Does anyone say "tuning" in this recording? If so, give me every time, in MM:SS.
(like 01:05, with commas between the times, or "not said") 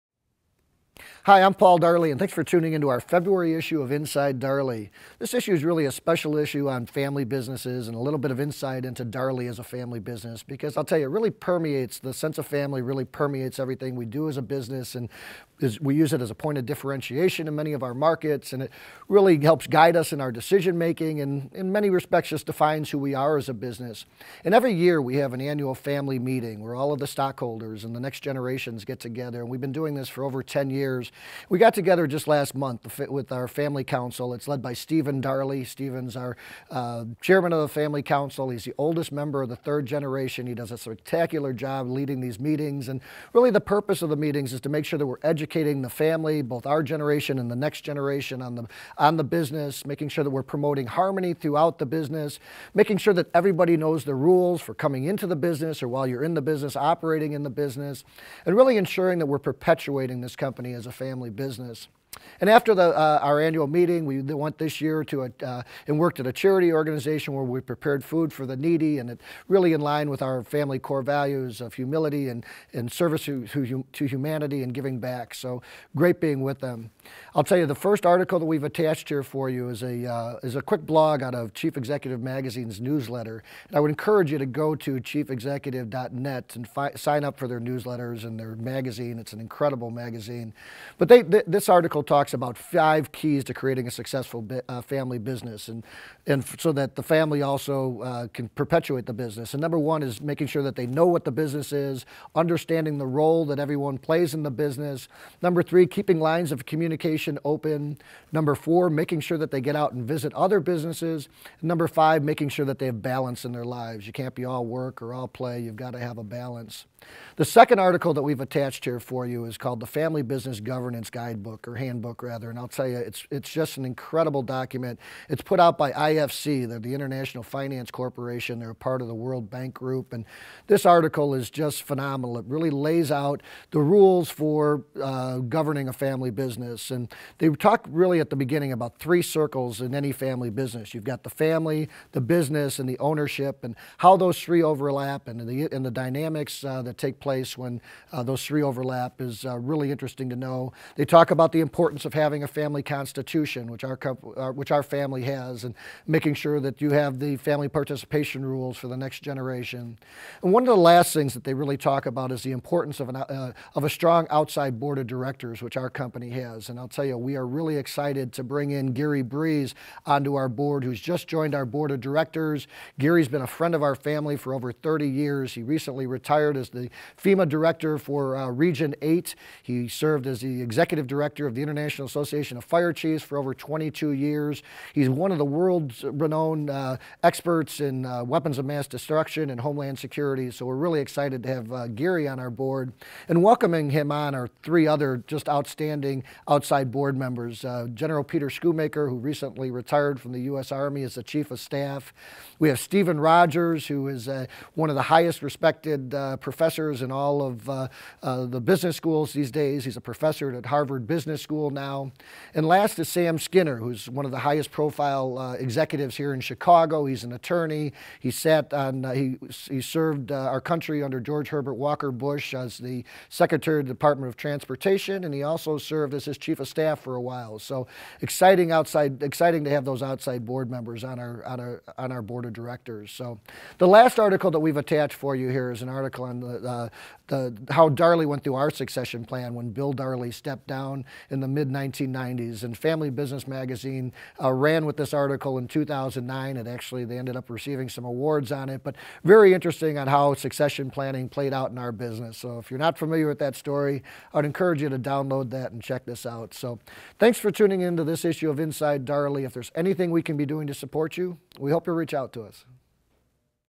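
00:02, 04:17.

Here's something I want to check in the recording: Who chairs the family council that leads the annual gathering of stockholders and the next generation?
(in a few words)
Stephen Darley.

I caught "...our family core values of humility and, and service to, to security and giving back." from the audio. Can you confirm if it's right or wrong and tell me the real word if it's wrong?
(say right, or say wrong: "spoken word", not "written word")
wrong: "humanity", not "security".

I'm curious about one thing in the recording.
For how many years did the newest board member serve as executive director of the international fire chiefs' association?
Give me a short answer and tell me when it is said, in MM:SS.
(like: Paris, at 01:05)
22, at 03:03.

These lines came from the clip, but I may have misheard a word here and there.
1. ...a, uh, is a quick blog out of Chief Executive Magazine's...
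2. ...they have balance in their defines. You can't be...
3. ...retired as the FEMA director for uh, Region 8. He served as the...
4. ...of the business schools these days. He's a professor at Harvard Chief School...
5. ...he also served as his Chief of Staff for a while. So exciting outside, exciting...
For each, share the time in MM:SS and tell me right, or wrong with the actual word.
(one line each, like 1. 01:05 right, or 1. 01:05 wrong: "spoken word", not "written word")
1. 01:19 right
2. 01:52 wrong: "lives", not "defines"
3. 02:56 right
4. 03:27 wrong: "Business", not "Chief"
5. 03:45 right.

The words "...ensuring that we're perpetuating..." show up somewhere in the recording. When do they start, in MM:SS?
00:58.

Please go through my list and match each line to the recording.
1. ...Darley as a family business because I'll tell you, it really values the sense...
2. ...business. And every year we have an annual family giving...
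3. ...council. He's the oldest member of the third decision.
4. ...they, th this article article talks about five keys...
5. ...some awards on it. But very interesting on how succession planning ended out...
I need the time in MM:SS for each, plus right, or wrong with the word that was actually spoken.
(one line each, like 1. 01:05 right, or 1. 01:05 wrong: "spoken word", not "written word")
1. 00:09 wrong: "permeates", not "values"
2. 00:23 wrong: "meeting", not "giving"
3. 00:38 wrong: "generation", not "decision"
4. 01:31 right
5. 04:07 wrong: "played", not "ended".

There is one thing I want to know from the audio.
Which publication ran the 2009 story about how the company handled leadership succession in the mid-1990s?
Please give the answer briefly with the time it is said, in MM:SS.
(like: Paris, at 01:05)
Family Business Magazine, at 04:02.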